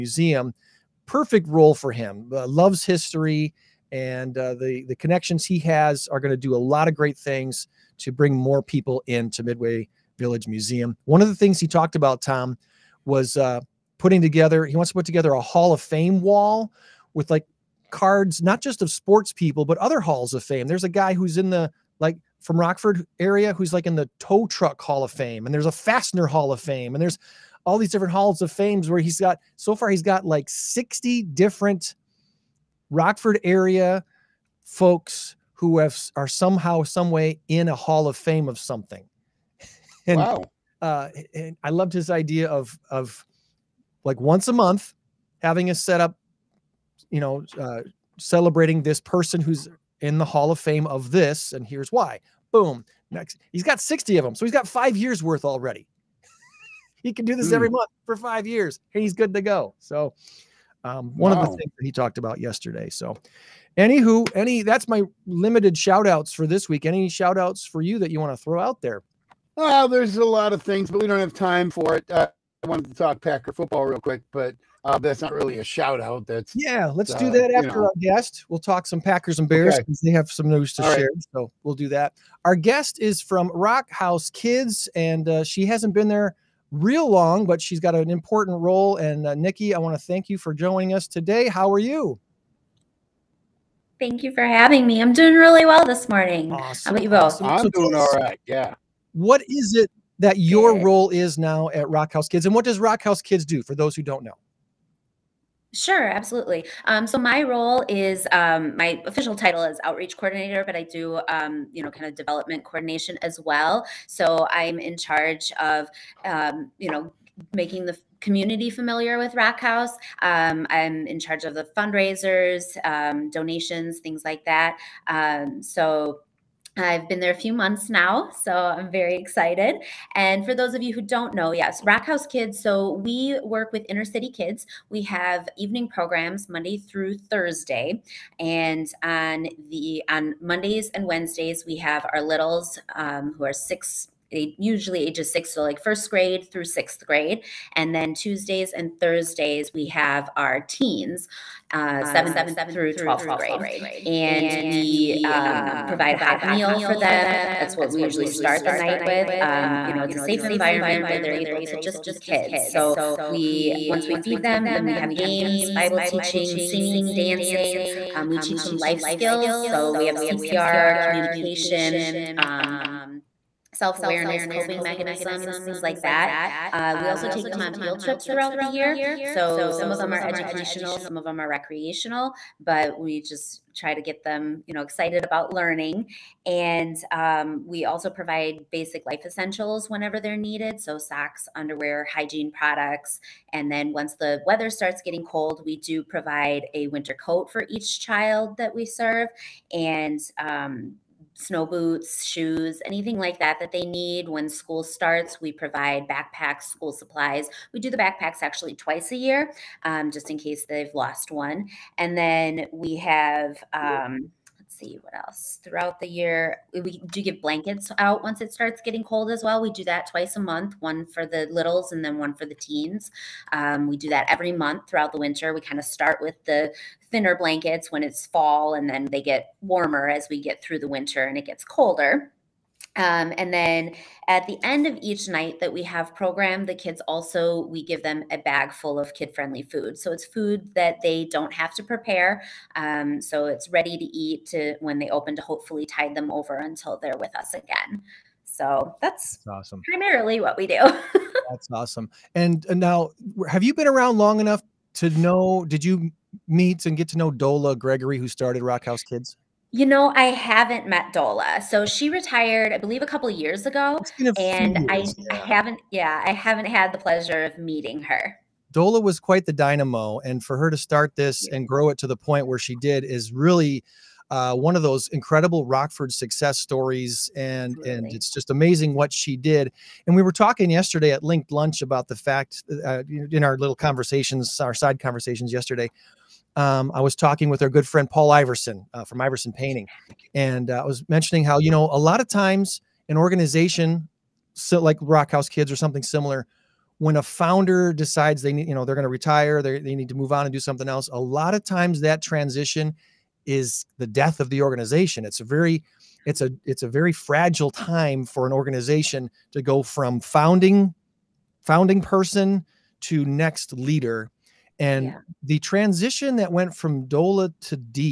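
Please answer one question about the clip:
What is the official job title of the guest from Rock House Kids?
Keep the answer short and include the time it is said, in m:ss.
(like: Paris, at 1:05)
Outreach coordinator, at 1:49.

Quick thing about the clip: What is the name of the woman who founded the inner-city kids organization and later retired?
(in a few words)
Dola Gregory.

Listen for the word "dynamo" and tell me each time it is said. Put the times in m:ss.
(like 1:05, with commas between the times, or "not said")
4:29.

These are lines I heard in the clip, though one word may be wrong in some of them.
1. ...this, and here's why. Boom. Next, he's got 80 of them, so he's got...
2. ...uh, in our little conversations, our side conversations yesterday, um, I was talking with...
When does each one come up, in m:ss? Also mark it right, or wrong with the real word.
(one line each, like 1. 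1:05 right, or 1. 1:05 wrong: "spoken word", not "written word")
1. 0:51 wrong: "60", not "80"
2. 4:42 right.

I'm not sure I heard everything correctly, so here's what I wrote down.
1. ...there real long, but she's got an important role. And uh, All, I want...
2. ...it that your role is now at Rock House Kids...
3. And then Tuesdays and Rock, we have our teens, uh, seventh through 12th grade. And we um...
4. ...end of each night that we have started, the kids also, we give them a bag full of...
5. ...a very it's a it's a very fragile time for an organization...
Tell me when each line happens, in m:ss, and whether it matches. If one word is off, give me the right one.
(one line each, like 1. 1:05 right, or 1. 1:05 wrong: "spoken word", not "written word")
1. 1:26 wrong: "Nikki", not "All"
2. 1:39 right
3. 2:27 wrong: "Thursdays", not "Rock"
4. 3:54 wrong: "programmed", not "started"
5. 5:05 right.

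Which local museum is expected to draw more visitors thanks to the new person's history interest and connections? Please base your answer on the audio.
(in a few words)
Midway Village Museum.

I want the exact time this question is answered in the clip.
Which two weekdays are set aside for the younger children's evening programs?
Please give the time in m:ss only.
2:20.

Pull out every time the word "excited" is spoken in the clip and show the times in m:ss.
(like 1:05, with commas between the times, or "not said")
2:09, 3:04.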